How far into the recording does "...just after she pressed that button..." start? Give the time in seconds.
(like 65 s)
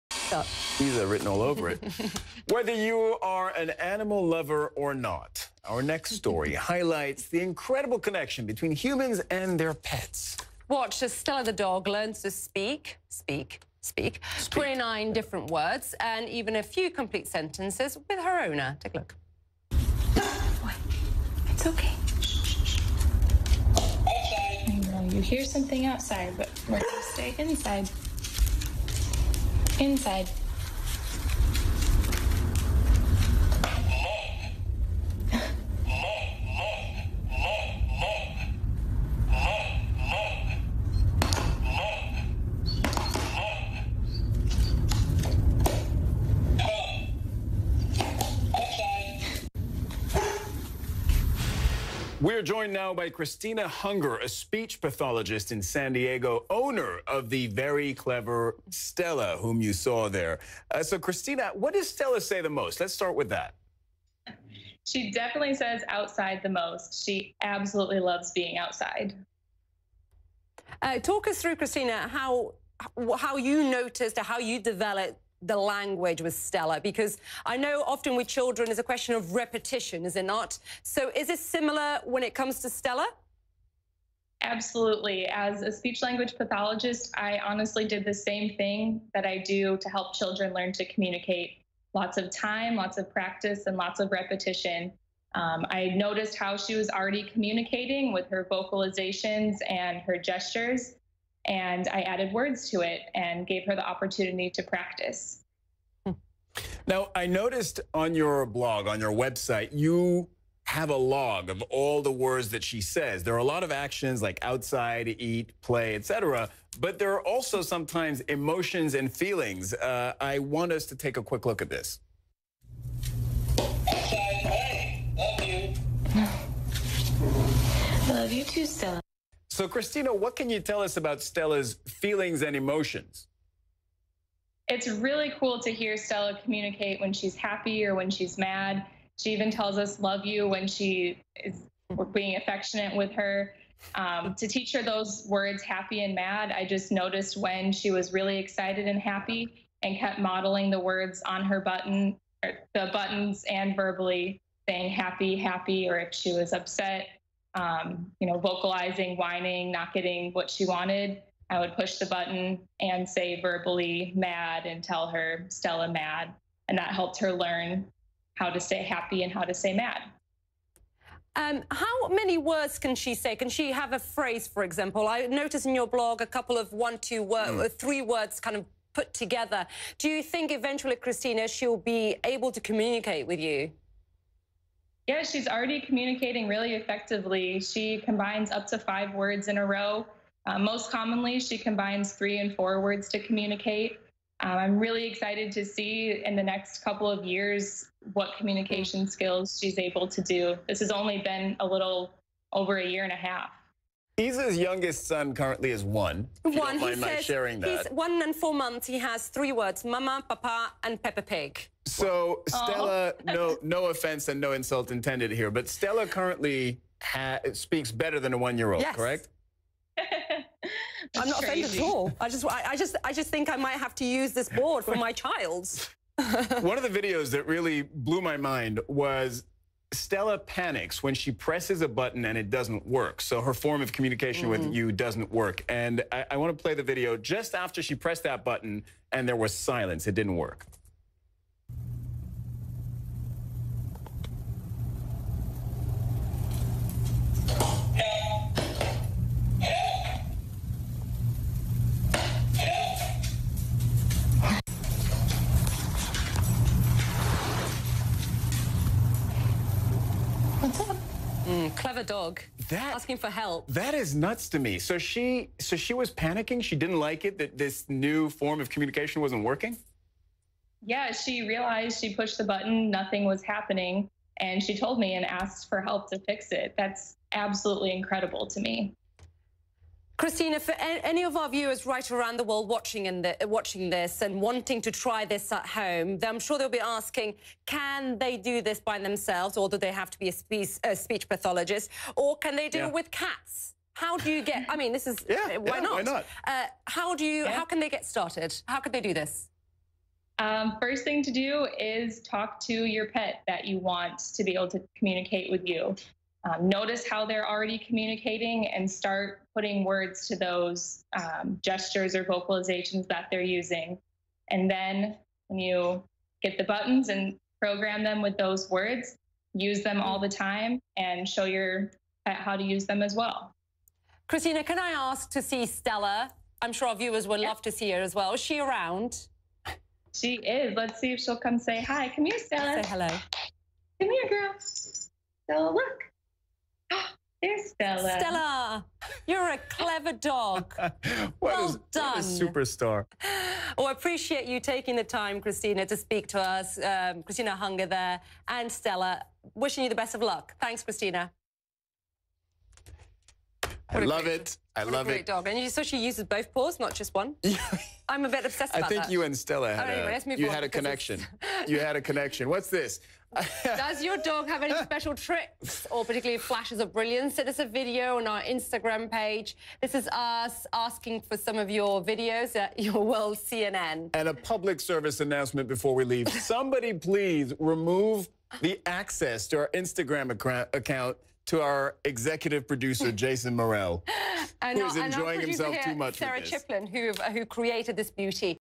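237 s.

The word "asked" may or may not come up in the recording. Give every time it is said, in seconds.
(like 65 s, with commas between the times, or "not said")
275 s.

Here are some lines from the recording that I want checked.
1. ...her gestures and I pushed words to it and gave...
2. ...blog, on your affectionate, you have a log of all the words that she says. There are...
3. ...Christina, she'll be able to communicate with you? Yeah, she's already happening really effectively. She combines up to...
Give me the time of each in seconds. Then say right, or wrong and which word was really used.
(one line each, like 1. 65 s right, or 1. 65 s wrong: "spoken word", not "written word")
1. 100 s wrong: "added", not "pushed"
2. 108 s wrong: "website", not "affectionate"
3. 180 s wrong: "communicating", not "happening".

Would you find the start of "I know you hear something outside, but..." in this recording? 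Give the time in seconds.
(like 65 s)
24 s.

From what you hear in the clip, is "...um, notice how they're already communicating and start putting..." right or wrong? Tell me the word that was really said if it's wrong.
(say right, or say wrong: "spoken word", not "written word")
right.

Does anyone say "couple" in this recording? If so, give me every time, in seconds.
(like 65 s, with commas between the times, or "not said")
176 s, 196 s.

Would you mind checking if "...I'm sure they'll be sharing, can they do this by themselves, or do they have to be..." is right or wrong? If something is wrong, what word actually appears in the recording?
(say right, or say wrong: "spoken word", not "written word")
wrong: "asking", not "sharing".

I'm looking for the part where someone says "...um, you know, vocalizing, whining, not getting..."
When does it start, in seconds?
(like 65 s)
157 s.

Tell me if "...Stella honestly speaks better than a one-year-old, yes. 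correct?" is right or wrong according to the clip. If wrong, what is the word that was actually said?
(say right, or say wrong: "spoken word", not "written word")
wrong: "currently", not "honestly".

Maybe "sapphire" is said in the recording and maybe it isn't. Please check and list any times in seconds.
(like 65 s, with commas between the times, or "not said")
not said.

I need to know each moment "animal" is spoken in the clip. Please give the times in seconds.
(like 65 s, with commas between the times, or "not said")
3 s.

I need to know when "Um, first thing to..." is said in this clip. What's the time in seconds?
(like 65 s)
300 s.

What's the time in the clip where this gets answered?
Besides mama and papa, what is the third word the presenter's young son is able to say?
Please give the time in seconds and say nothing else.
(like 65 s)
211 s.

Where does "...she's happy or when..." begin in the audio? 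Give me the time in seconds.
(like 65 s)
137 s.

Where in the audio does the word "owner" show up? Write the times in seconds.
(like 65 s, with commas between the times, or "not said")
18 s, 56 s.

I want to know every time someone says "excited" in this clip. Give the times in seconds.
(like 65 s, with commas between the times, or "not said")
148 s, 195 s.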